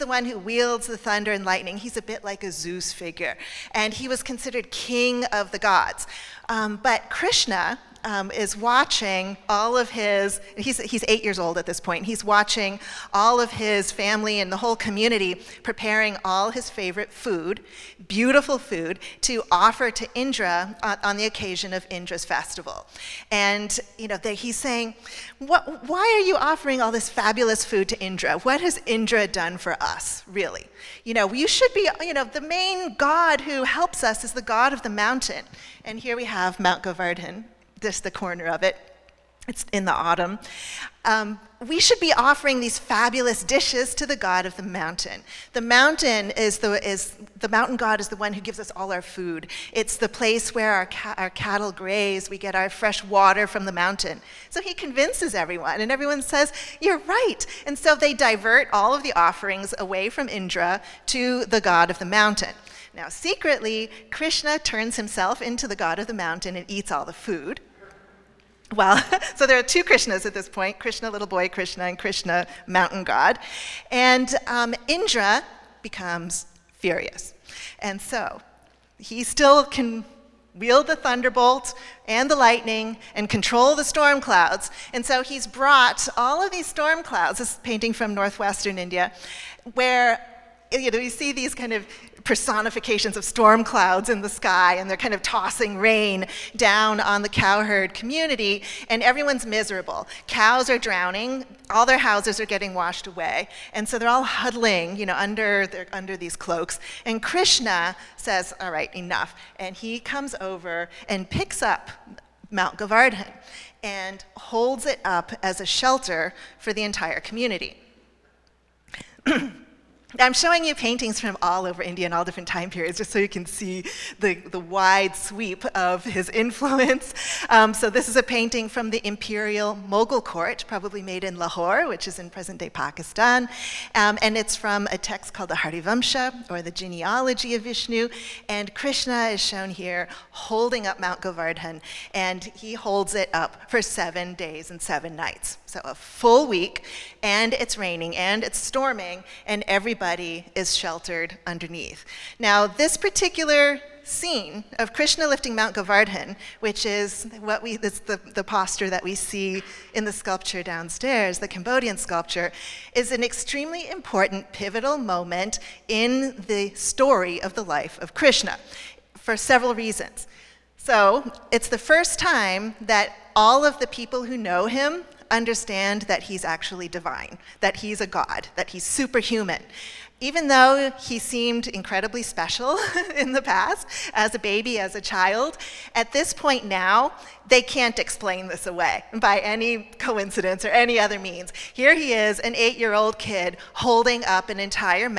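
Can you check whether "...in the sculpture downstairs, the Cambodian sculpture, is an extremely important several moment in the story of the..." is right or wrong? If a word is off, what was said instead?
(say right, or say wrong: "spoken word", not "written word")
wrong: "pivotal", not "several".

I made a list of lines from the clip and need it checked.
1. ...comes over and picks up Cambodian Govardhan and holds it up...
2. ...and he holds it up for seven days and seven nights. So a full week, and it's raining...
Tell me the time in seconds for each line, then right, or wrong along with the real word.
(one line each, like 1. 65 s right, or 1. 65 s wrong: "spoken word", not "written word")
1. 109 s wrong: "Mount", not "Cambodian"
2. 142 s right.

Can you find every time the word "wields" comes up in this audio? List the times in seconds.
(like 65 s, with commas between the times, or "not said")
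0 s, 80 s.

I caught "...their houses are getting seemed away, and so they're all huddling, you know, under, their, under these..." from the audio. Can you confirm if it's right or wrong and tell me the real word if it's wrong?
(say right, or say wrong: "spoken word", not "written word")
wrong: "washed", not "seemed".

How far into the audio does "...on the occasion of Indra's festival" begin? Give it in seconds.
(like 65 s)
21 s.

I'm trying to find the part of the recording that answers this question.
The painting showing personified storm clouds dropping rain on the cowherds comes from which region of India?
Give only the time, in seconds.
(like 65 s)
88 s.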